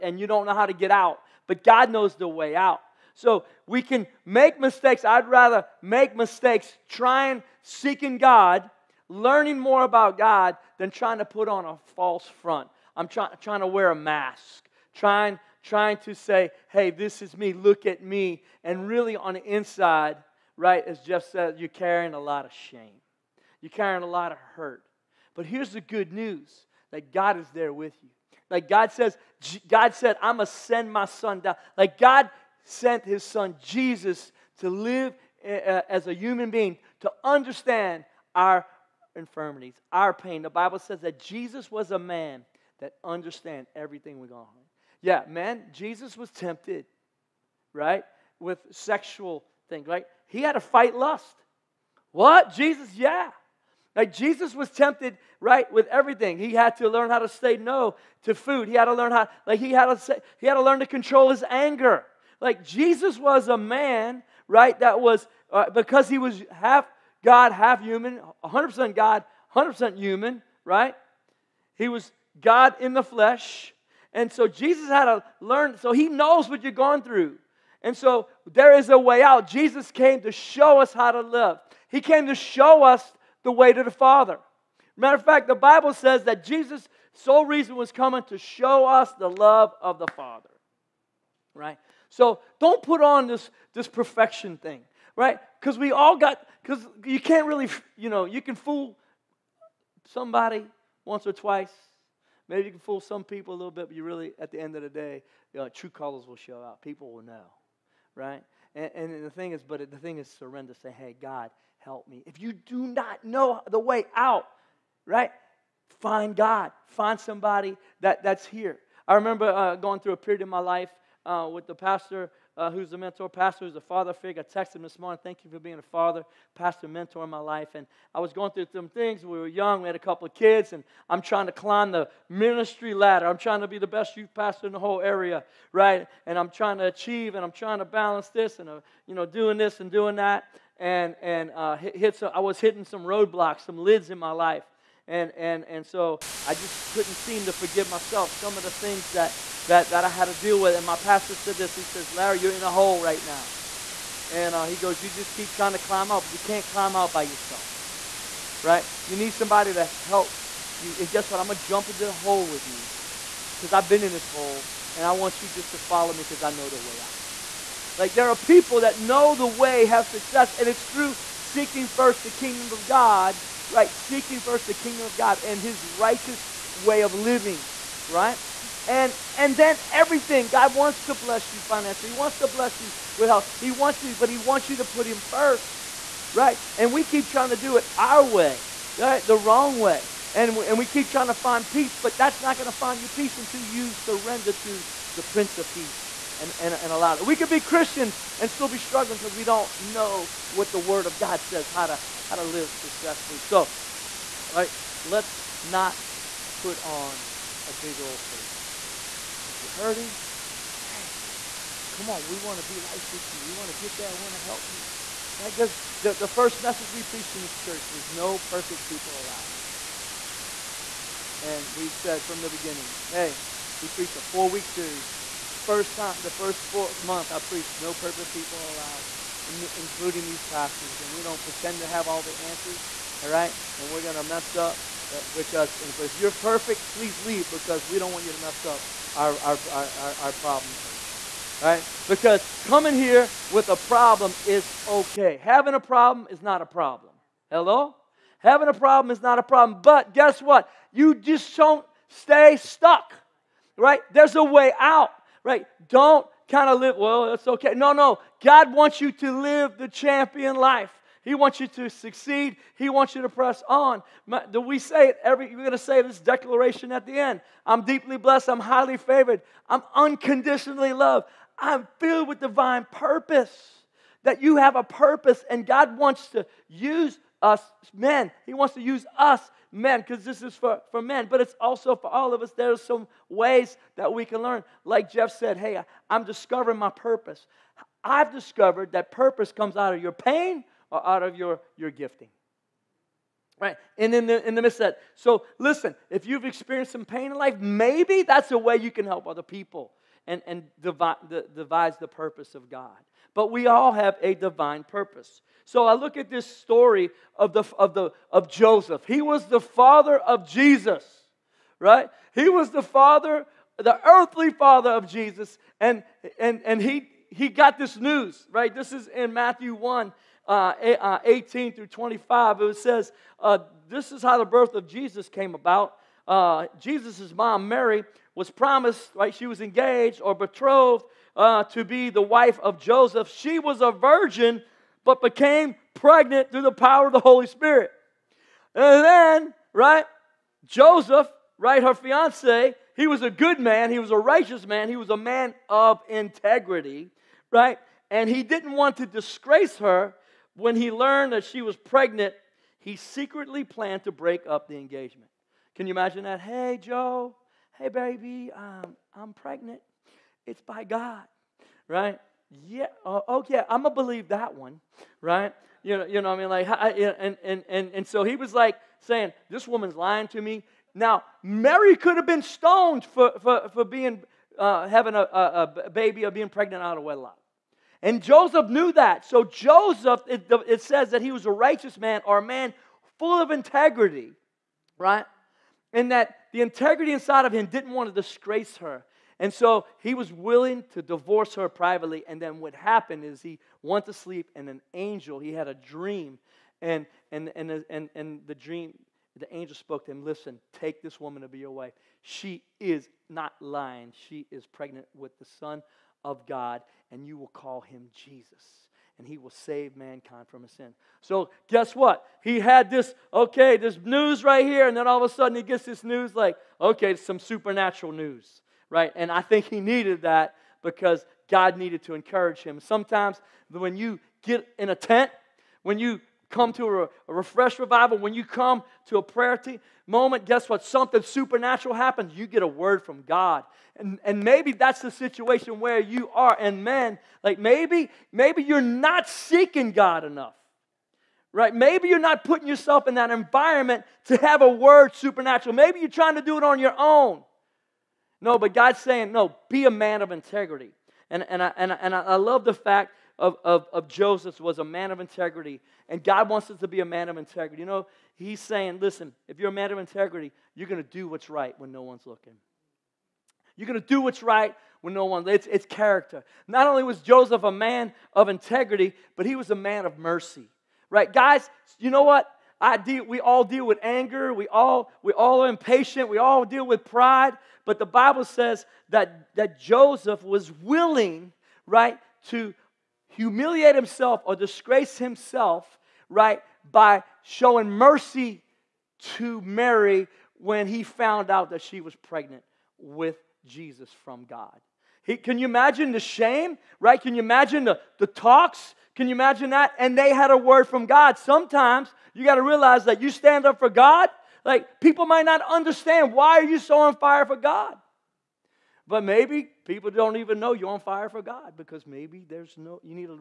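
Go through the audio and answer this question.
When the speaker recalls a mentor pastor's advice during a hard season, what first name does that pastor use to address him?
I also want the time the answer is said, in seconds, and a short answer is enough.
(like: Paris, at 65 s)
Larry, at 152 s.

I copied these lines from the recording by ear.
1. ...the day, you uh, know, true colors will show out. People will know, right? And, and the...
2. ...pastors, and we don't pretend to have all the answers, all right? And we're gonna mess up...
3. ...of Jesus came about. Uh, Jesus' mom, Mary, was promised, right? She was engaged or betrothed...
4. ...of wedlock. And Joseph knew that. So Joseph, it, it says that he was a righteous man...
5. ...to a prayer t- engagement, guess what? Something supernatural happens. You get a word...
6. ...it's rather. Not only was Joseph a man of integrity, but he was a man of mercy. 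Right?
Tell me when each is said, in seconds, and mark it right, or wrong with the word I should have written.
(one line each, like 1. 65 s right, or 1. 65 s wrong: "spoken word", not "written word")
1. 104 s right
2. 230 s right
3. 324 s right
4. 376 s right
5. 429 s wrong: "moment", not "engagement"
6. 465 s wrong: "character", not "rather".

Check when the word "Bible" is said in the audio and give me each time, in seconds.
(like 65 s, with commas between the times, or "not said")
40 s, 85 s, 478 s.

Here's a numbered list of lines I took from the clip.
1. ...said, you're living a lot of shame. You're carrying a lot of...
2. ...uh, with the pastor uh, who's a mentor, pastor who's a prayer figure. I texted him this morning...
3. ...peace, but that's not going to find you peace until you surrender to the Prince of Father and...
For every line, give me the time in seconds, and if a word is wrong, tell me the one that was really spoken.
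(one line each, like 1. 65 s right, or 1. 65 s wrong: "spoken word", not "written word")
1. 21 s wrong: "carrying", not "living"
2. 121 s wrong: "father", not "prayer"
3. 191 s wrong: "Peace", not "Father".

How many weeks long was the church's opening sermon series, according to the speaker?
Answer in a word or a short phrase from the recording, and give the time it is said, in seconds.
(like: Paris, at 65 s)
4, at 224 s.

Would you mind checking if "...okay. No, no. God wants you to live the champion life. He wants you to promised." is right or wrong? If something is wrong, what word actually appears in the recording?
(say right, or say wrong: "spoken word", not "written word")
wrong: "succeed", not "promised".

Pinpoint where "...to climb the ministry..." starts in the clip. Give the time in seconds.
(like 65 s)
131 s.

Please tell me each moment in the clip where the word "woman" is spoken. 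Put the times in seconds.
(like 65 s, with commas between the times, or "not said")
369 s, 401 s.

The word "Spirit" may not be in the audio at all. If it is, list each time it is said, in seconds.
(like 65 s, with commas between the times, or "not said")
337 s.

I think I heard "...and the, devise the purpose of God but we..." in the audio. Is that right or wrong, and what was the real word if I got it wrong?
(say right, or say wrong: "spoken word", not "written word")
right.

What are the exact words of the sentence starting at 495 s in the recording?
He, can you imagine the shame, right?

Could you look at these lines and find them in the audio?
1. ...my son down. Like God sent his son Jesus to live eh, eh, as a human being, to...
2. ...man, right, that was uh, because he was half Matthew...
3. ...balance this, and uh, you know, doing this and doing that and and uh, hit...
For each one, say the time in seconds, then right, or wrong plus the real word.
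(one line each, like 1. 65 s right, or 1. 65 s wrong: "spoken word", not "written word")
1. 30 s right
2. 63 s wrong: "God", not "Matthew"
3. 137 s right.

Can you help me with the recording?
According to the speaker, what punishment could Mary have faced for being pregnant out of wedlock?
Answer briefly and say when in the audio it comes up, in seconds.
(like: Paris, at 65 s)
Stoned, at 372 s.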